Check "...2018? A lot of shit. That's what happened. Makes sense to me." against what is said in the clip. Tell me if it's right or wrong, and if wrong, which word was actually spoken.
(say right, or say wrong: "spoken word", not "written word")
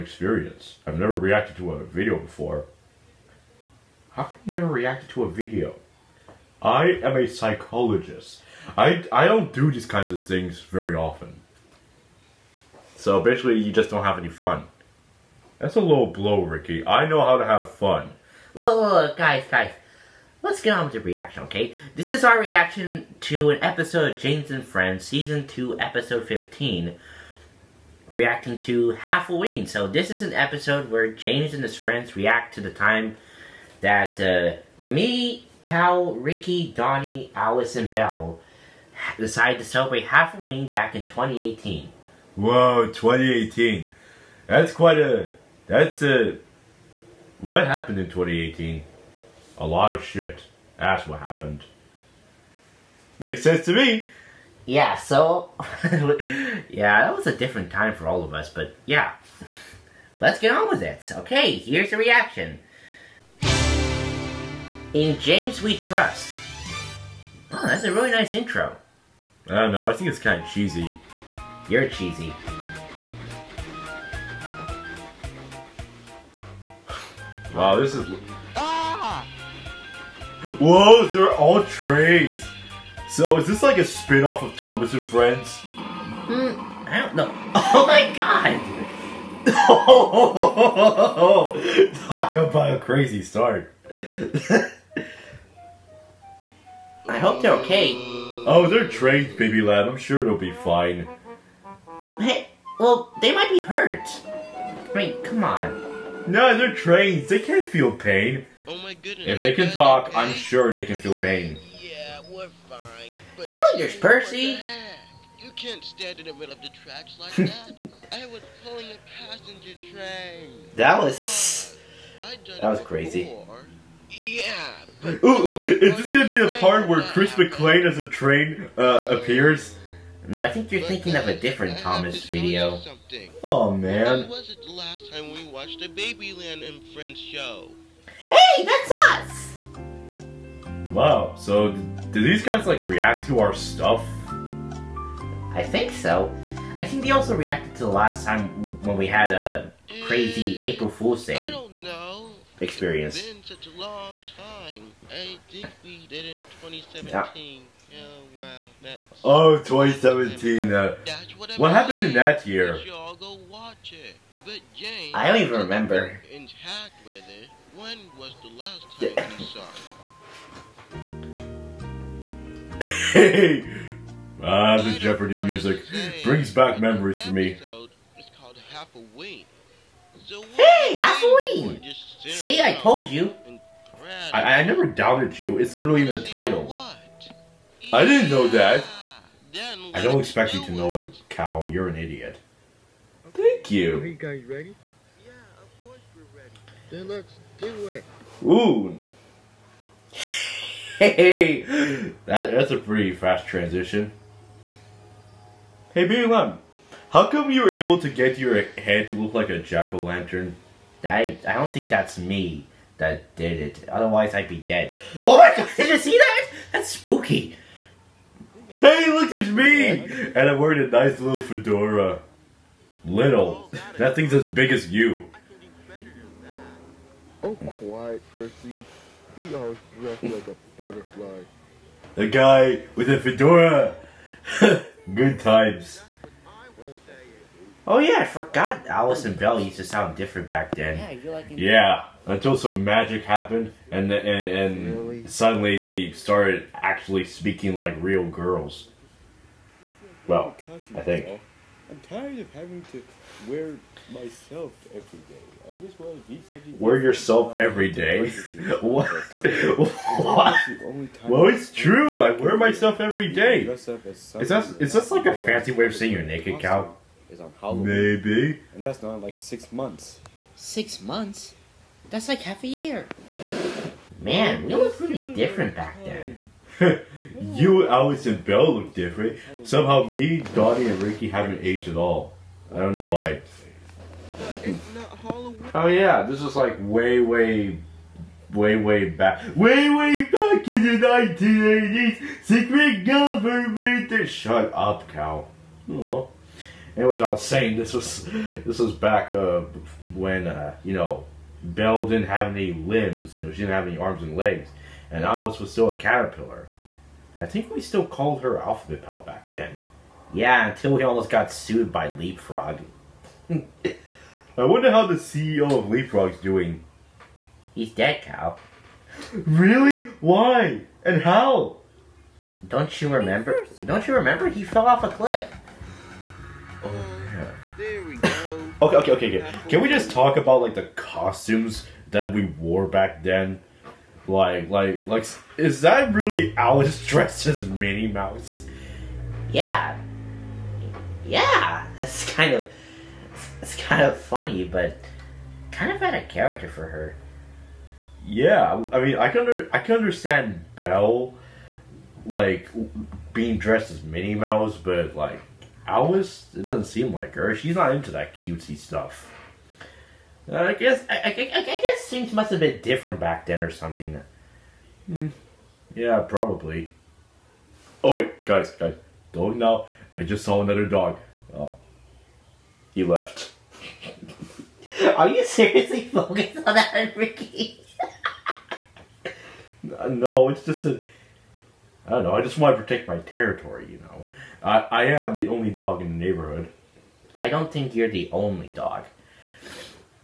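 right.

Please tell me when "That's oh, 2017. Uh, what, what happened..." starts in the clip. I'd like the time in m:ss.
2:38.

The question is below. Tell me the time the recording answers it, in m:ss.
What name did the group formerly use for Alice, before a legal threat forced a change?
5:08.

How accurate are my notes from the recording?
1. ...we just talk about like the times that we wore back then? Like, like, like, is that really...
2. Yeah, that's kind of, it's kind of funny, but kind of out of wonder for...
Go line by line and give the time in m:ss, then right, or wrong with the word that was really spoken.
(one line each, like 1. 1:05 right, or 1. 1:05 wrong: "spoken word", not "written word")
1. 5:29 wrong: "costumes", not "times"
2. 5:41 wrong: "character", not "wonder".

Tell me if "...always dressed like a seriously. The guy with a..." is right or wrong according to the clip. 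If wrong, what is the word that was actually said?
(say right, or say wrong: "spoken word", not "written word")
wrong: "butterfly", not "seriously".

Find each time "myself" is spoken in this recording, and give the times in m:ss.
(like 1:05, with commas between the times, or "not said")
4:14, 4:22.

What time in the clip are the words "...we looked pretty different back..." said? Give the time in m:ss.
4:34.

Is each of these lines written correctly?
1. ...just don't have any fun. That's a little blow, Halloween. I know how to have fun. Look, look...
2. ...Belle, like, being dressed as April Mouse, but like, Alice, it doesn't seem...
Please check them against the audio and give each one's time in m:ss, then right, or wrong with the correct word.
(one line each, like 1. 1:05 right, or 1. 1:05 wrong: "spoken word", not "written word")
1. 0:13 wrong: "Ricky", not "Halloween"
2. 5:50 wrong: "Minnie", not "April".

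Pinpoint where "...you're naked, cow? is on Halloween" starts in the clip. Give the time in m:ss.
4:26.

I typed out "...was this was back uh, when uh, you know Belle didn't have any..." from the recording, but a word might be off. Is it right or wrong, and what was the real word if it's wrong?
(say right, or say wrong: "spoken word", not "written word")
right.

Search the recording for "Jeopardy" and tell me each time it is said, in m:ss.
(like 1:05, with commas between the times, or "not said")
2:54.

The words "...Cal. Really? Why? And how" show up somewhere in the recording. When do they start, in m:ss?
5:18.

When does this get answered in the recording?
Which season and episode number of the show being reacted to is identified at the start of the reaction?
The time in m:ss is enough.
0:25.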